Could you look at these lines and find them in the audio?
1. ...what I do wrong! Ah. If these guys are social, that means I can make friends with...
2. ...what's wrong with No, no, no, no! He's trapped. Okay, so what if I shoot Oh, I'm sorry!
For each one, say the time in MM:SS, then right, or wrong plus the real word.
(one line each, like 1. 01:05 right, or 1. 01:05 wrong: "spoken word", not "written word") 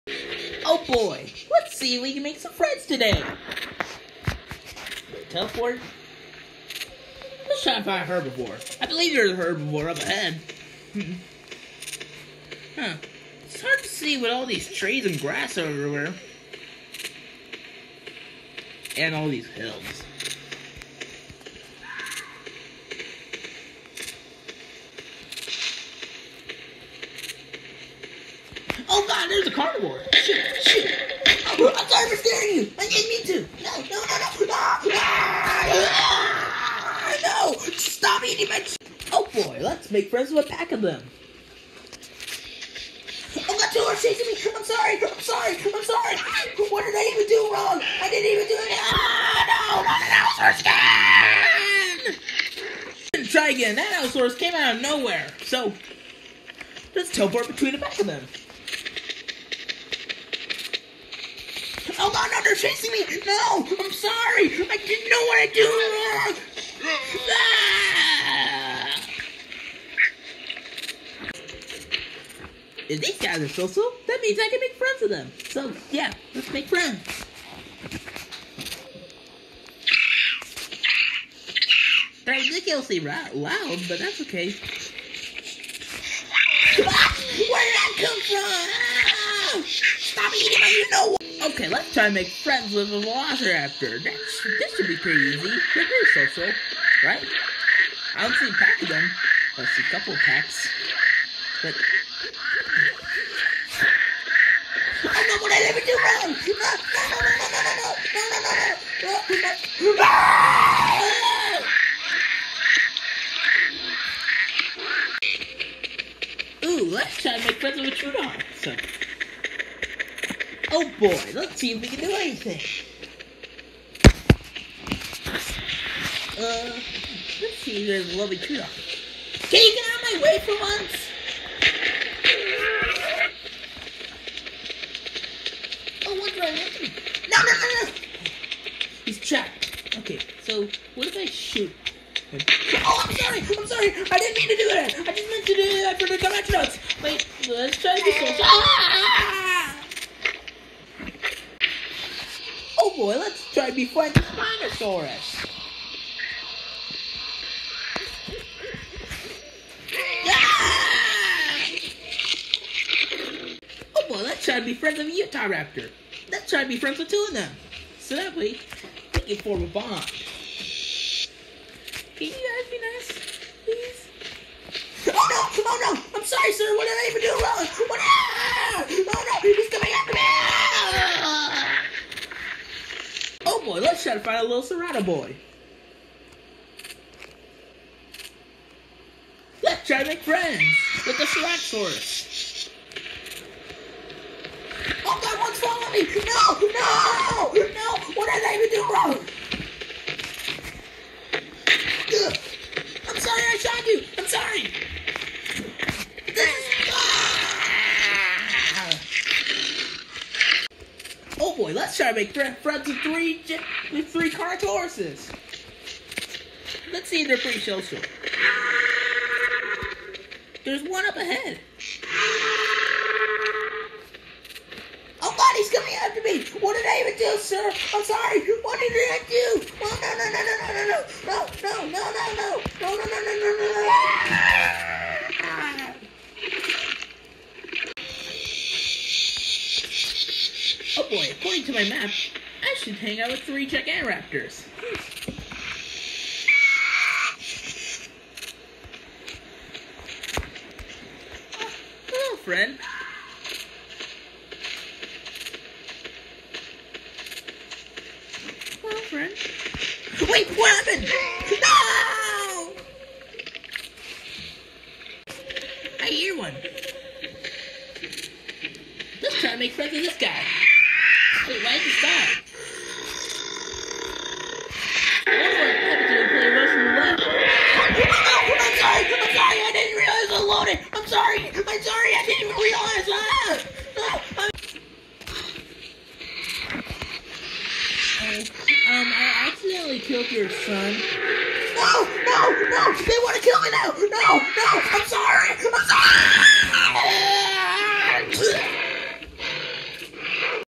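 1. 01:05 right
2. 02:16 right.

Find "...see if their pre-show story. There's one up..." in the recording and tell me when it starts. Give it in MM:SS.
03:37.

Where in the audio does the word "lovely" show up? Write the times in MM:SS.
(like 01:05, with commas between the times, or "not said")
02:08.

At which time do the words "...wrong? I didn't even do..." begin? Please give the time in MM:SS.
00:47.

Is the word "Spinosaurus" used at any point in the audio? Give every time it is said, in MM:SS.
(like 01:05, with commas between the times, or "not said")
02:34.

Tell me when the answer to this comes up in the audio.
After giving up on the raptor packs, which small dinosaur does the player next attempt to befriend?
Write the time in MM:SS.
01:57.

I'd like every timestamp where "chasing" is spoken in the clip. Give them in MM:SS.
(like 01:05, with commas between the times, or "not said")
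00:43, 01:02.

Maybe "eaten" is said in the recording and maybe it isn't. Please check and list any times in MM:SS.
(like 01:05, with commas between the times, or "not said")
not said.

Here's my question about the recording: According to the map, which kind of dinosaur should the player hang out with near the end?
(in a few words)
Gigantoraptors.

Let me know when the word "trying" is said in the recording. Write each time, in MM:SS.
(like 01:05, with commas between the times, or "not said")
03:31.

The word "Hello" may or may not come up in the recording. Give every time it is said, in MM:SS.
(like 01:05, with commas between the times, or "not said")
04:12, 04:18.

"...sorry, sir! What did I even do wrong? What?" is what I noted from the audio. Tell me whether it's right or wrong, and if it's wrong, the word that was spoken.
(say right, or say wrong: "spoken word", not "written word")
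right.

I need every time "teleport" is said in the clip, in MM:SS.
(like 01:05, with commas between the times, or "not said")
00:05, 00:57.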